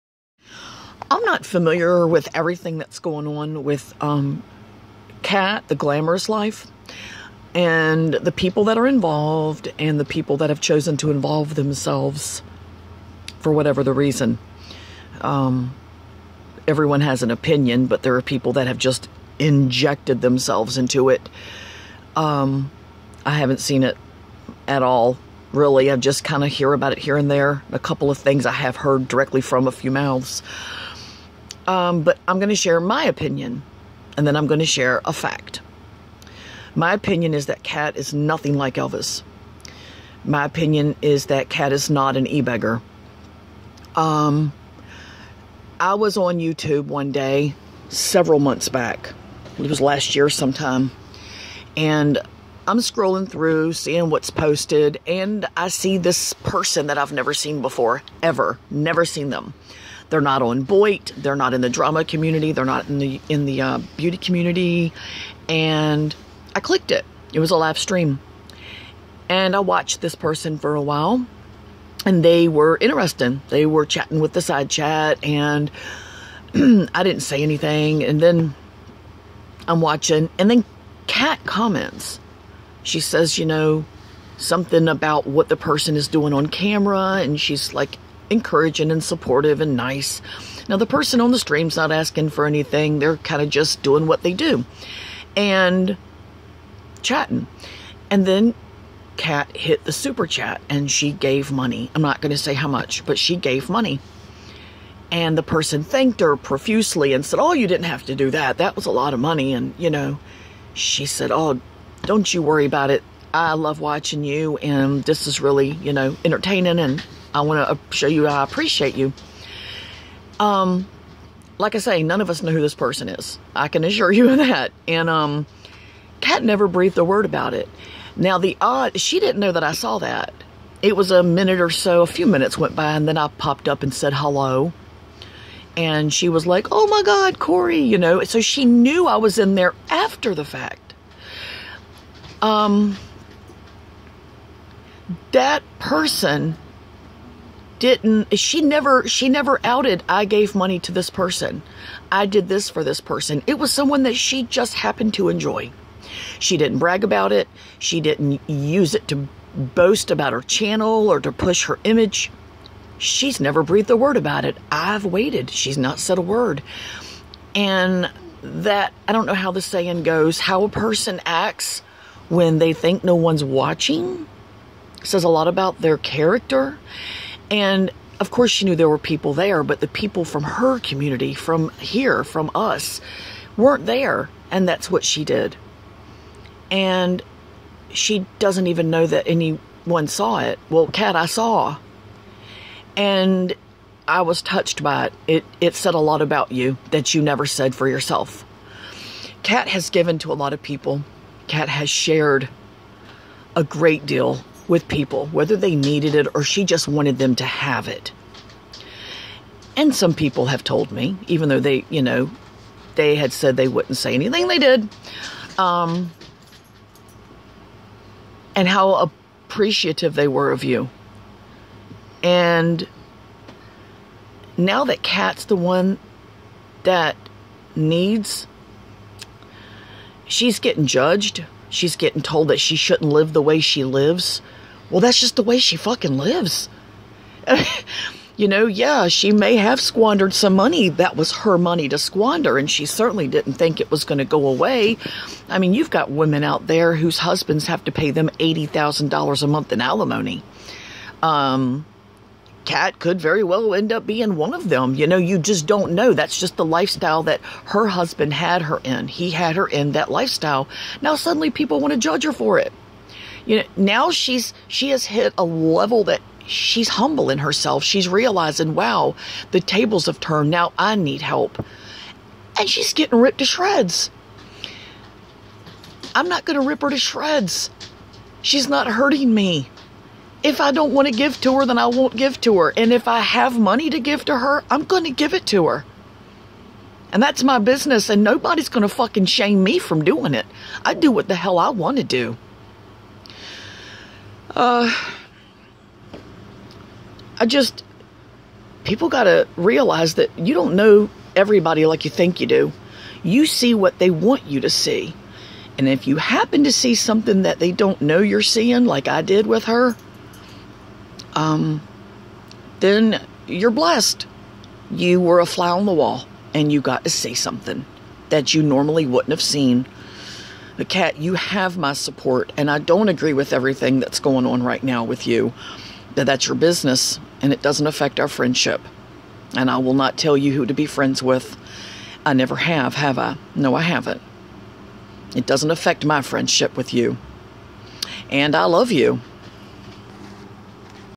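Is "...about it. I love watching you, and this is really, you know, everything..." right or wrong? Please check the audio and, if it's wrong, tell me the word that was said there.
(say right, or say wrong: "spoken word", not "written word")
wrong: "entertaining", not "everything".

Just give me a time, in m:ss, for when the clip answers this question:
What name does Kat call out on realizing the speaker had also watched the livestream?
2:17.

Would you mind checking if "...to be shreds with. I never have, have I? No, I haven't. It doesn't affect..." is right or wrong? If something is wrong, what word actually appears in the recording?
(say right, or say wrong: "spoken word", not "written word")
wrong: "friends", not "shreds".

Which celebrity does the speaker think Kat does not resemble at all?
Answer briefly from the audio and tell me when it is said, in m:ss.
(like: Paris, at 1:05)
Elvis, at 0:38.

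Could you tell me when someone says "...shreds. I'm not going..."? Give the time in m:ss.
4:33.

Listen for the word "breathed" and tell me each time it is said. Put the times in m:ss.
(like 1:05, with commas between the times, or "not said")
2:06, 2:43.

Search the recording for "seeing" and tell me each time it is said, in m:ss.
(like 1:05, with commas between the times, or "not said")
0:53, 5:08.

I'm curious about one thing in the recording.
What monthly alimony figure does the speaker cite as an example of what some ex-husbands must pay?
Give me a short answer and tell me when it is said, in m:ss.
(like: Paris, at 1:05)
$80,000, at 4:08.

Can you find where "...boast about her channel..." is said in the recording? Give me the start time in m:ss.
2:39.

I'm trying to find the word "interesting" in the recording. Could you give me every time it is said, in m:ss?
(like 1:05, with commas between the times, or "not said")
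1:12.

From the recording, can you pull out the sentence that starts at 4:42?
And if I have money to give to her, I'm going to give it to her.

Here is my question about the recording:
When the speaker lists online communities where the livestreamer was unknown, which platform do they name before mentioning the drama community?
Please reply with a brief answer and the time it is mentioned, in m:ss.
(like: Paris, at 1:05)
Boit, at 1:00.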